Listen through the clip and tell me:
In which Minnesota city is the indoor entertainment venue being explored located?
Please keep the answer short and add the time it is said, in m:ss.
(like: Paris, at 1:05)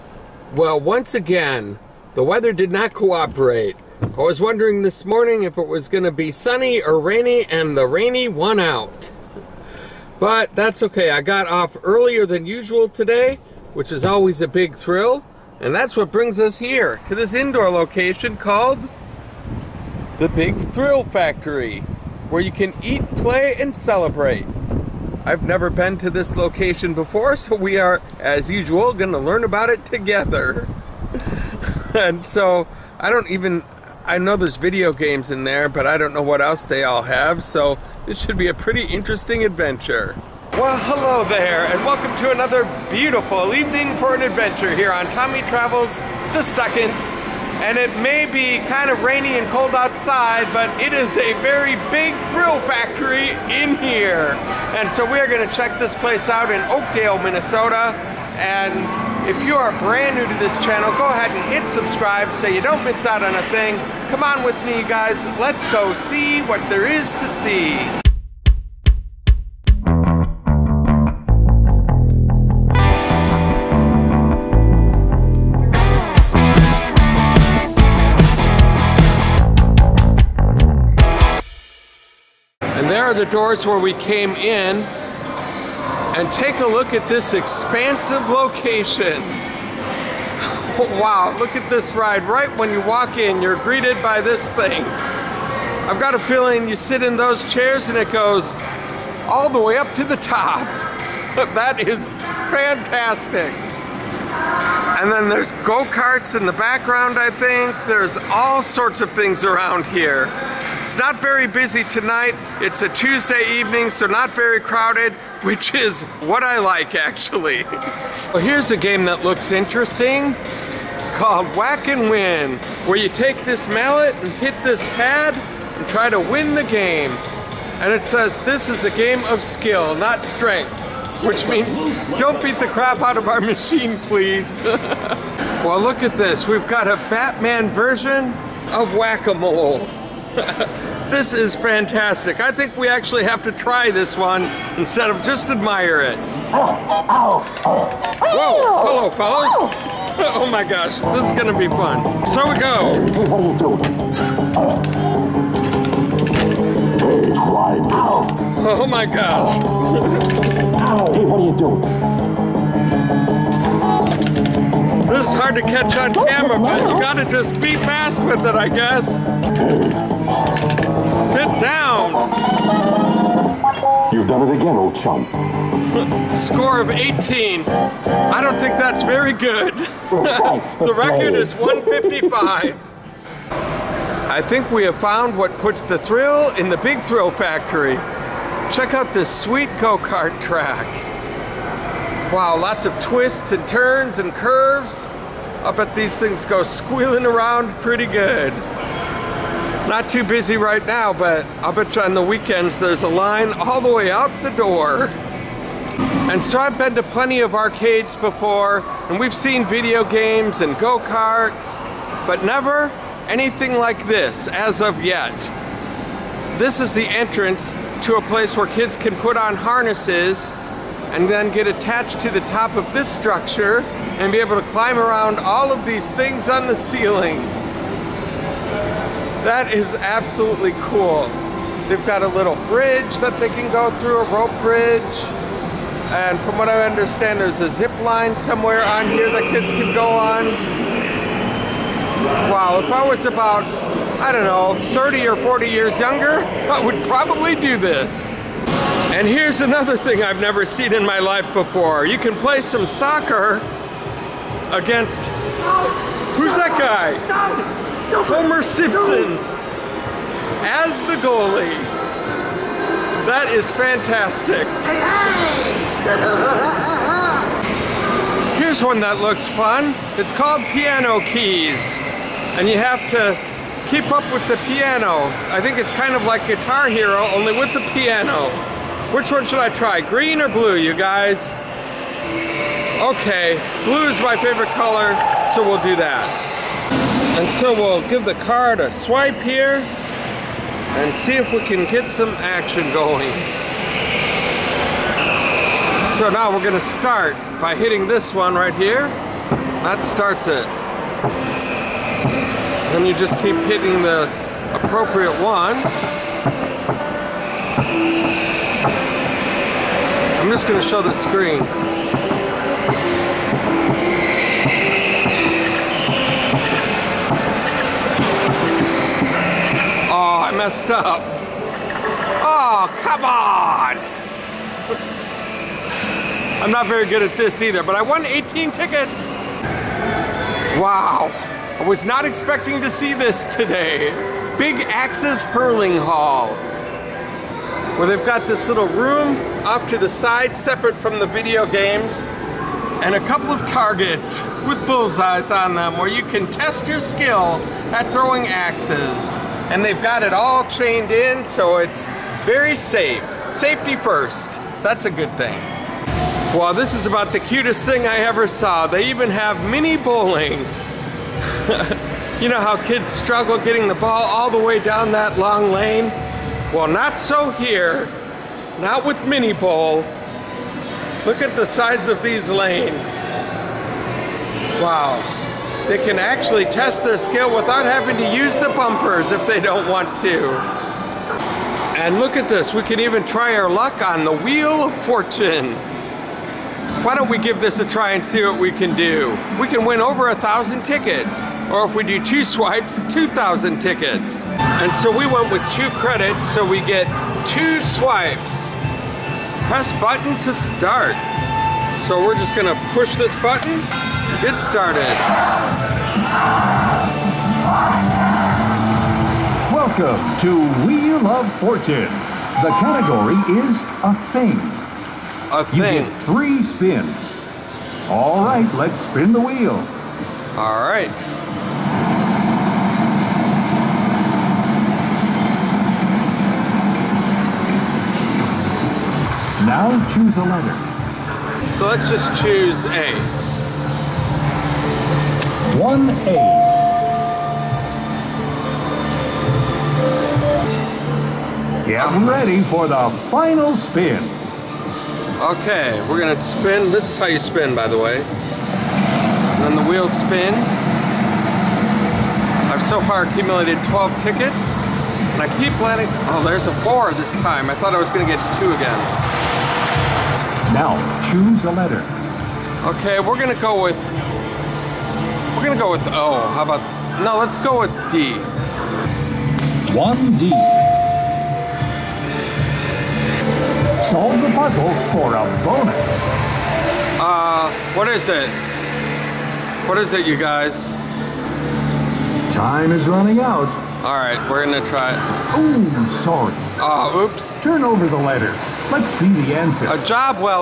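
Oakdale, at 0:56.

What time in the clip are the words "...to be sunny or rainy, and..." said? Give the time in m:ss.
0:06.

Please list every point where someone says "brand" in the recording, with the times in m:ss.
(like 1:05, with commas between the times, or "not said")
0:59.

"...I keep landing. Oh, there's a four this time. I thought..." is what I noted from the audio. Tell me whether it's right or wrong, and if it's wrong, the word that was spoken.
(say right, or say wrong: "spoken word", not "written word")
right.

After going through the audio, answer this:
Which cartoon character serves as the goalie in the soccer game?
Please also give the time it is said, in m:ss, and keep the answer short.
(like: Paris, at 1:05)
Homer Simpson, at 4:18.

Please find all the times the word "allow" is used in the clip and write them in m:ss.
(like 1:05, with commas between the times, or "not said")
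not said.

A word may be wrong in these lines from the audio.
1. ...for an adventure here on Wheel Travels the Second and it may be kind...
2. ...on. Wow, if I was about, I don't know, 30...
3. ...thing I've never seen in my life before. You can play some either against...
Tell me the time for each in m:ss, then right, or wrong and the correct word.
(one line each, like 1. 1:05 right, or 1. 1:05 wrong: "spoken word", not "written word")
1. 0:43 wrong: "Tommy", not "Wheel"
2. 4:00 right
3. 4:09 wrong: "soccer", not "either".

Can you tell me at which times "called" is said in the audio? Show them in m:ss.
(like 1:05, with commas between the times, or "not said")
0:18, 2:01, 4:30.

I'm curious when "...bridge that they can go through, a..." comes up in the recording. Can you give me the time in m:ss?
3:52.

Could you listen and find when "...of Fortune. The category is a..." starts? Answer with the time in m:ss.
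6:51.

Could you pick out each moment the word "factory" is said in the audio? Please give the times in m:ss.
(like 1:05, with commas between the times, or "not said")
0:21, 0:52, 3:07.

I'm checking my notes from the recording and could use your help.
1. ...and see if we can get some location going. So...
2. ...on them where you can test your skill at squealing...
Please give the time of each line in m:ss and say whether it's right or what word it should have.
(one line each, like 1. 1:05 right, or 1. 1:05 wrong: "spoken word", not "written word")
1. 4:49 wrong: "action", not "location"
2. 5:45 wrong: "throwing", not "squealing".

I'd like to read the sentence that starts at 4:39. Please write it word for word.
Which one should I try, green or blue, you guys?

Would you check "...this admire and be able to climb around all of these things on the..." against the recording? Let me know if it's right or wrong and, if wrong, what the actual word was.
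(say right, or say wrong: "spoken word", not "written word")
wrong: "structure", not "admire".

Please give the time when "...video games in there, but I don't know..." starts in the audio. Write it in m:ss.
0:34.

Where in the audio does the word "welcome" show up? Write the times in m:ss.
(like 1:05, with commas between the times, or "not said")
0:41, 6:49.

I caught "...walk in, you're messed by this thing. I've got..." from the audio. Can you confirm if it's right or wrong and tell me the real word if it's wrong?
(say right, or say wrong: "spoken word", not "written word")
wrong: "greeted", not "messed".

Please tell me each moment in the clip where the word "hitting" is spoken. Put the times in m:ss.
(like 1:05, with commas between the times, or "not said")
4:57, 5:03.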